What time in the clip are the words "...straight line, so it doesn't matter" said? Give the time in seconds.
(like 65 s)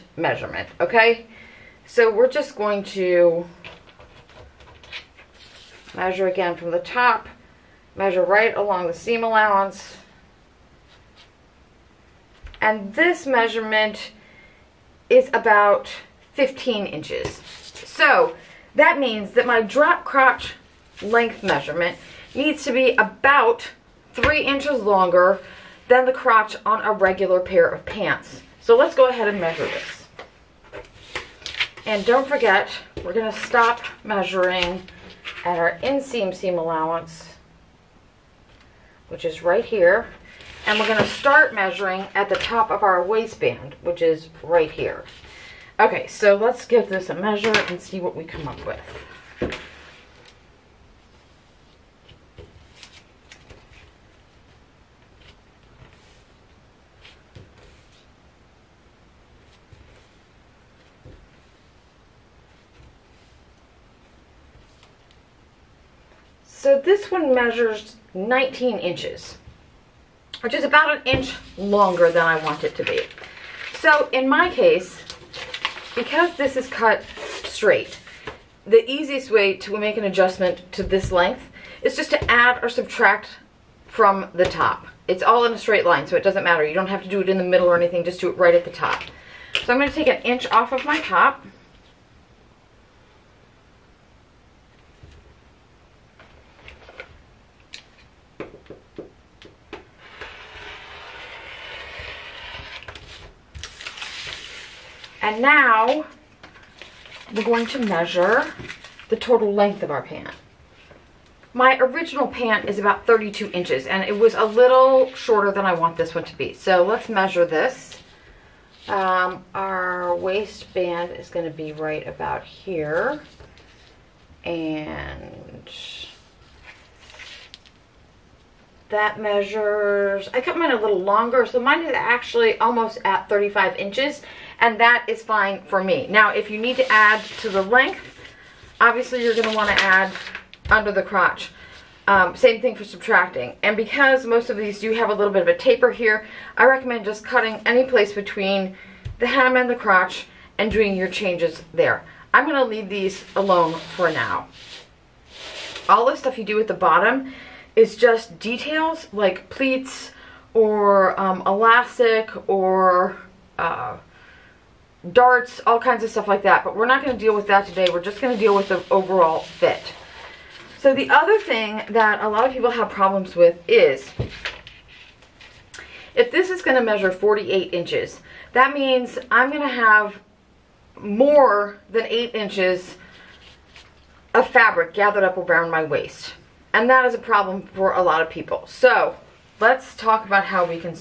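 85 s.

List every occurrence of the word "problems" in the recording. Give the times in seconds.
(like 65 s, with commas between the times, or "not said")
172 s, 187 s.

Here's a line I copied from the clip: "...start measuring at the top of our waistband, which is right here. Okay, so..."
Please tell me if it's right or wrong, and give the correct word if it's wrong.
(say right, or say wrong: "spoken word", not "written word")
right.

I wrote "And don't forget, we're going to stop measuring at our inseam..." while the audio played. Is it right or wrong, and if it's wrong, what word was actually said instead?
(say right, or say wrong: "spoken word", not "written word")
right.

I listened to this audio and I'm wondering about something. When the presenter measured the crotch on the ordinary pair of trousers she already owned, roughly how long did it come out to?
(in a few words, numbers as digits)
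15 inches.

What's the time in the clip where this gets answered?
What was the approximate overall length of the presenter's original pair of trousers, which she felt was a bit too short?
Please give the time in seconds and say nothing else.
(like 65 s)
113 s.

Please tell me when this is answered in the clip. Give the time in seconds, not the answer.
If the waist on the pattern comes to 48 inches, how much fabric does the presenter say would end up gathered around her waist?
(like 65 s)
180 s.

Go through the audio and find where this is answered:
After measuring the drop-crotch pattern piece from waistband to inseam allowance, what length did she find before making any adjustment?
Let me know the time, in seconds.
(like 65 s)
68 s.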